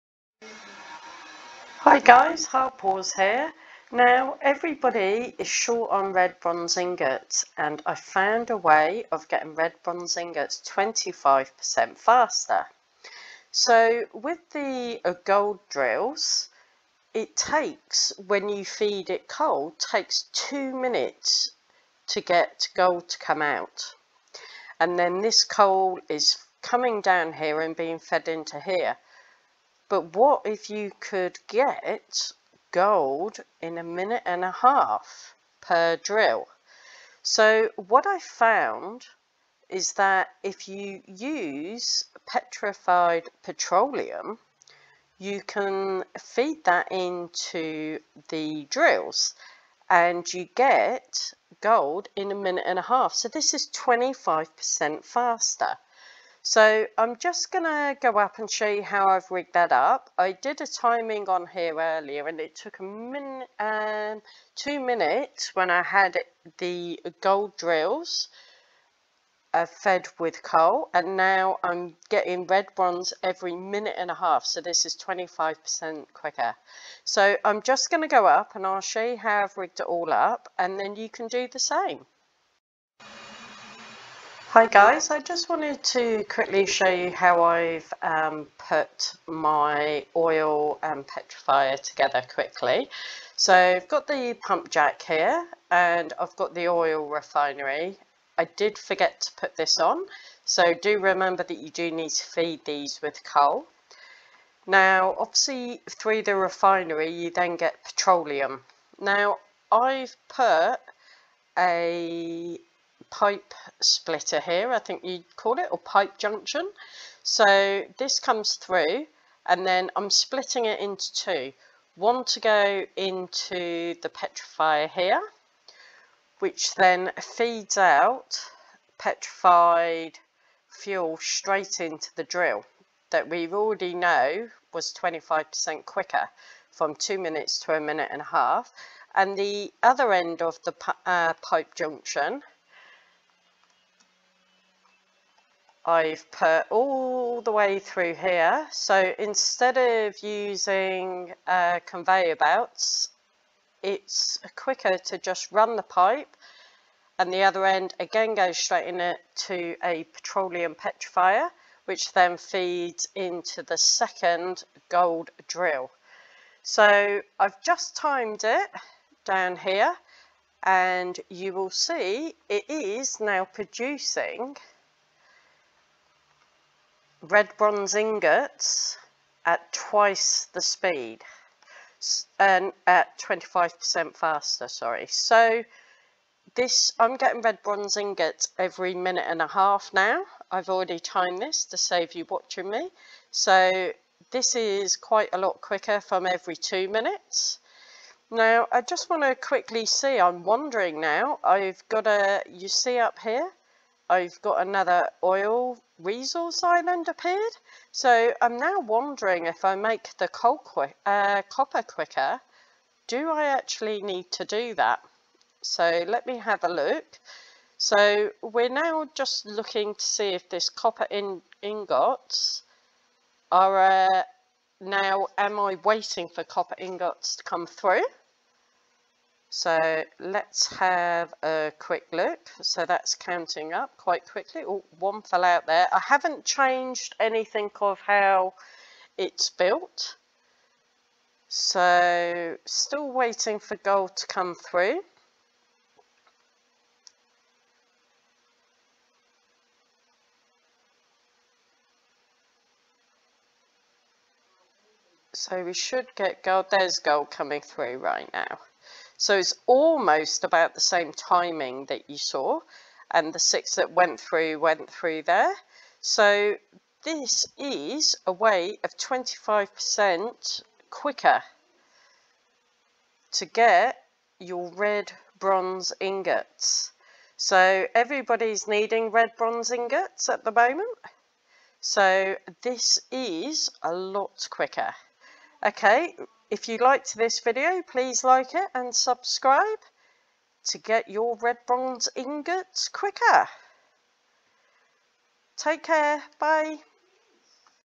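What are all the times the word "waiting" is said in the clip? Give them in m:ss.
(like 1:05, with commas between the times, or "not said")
3:45, 4:03.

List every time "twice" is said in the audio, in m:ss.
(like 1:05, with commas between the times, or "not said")
2:59.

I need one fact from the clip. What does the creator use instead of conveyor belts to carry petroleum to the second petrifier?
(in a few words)
the pipe.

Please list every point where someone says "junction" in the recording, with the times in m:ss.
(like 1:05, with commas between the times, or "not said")
1:56, 2:21.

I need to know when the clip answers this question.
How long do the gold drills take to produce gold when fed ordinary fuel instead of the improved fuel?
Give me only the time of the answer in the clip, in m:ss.
0:19.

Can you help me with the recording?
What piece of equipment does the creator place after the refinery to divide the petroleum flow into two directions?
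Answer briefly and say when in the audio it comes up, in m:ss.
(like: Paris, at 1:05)
pipe splitter, at 1:53.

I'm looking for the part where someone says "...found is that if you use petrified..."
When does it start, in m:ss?
0:38.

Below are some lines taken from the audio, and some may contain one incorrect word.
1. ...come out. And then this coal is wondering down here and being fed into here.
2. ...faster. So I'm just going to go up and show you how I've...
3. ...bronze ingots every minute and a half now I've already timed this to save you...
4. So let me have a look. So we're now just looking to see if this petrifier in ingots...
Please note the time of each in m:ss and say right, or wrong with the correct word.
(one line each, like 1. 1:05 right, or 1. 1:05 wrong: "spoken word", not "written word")
1. 0:23 wrong: "coming", not "wondering"
2. 0:55 right
3. 3:07 right
4. 3:35 wrong: "copper", not "petrifier".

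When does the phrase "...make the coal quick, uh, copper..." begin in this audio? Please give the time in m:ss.
3:29.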